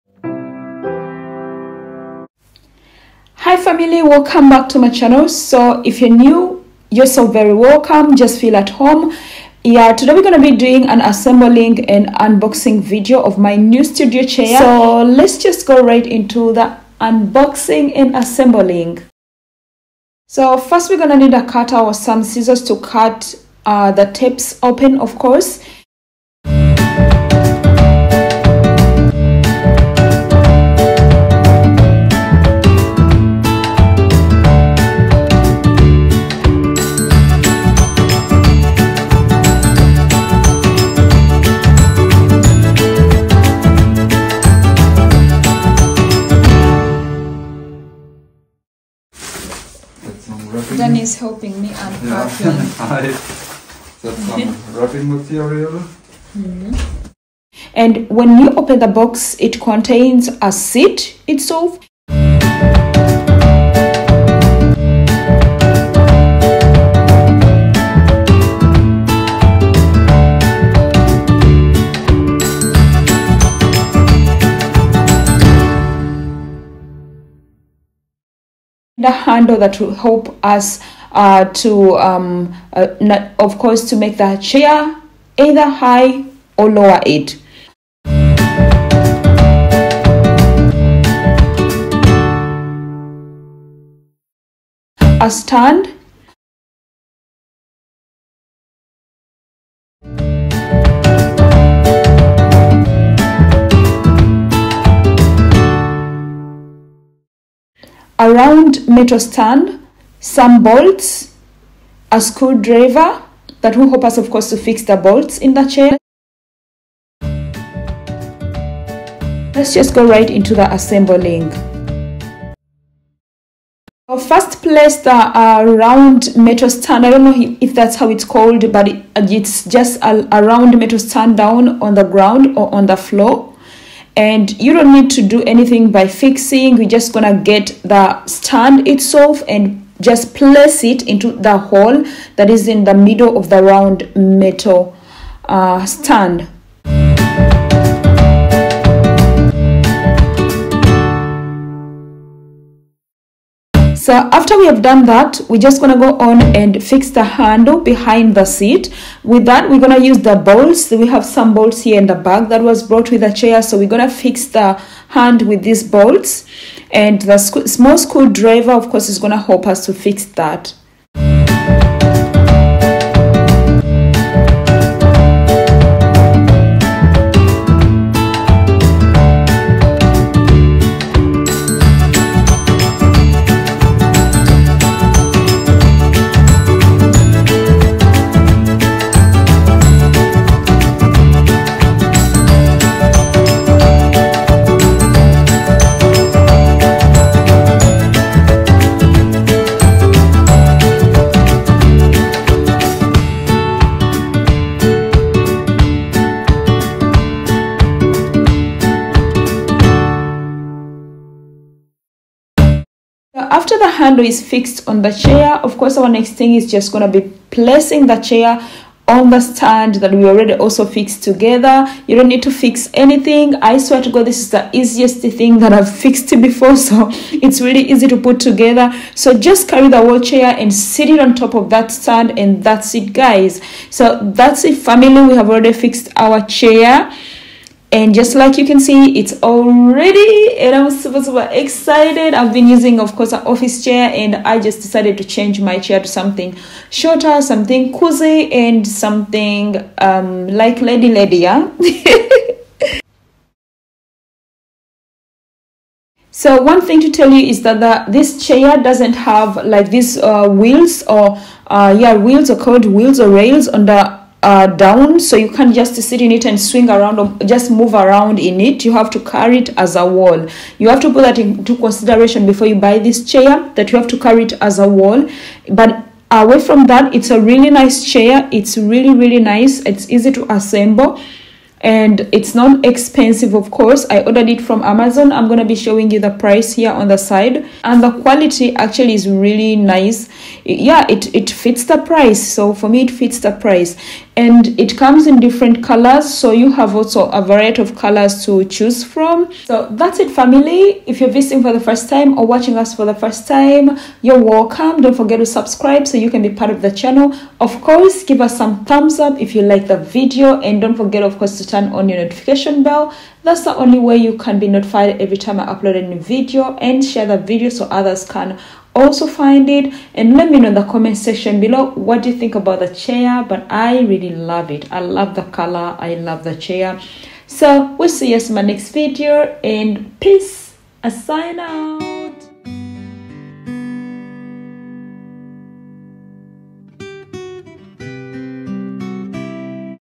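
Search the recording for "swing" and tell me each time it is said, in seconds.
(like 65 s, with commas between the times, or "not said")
266 s.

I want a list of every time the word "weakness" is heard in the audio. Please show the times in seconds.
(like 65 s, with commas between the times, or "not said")
not said.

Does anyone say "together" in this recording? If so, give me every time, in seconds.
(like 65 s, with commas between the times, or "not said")
221 s, 228 s.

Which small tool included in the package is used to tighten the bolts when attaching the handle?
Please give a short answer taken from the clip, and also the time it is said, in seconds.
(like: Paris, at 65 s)
screwdriver, at 112 s.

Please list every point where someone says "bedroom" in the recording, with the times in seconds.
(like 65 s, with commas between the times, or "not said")
not said.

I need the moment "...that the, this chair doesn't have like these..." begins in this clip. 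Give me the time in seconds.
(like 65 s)
257 s.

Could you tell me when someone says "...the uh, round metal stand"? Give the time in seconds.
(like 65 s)
124 s.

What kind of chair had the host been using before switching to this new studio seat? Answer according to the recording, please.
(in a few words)
office chair.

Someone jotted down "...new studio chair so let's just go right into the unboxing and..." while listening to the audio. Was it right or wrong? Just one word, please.
right.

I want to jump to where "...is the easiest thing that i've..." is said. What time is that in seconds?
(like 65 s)
224 s.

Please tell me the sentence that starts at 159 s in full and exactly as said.
With that, we're going to use the bolts.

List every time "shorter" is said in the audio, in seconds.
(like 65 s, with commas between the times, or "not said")
246 s.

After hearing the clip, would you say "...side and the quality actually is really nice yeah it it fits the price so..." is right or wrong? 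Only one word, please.
right.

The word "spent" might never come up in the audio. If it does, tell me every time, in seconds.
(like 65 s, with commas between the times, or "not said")
not said.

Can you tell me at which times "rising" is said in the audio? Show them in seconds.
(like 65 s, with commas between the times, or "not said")
not said.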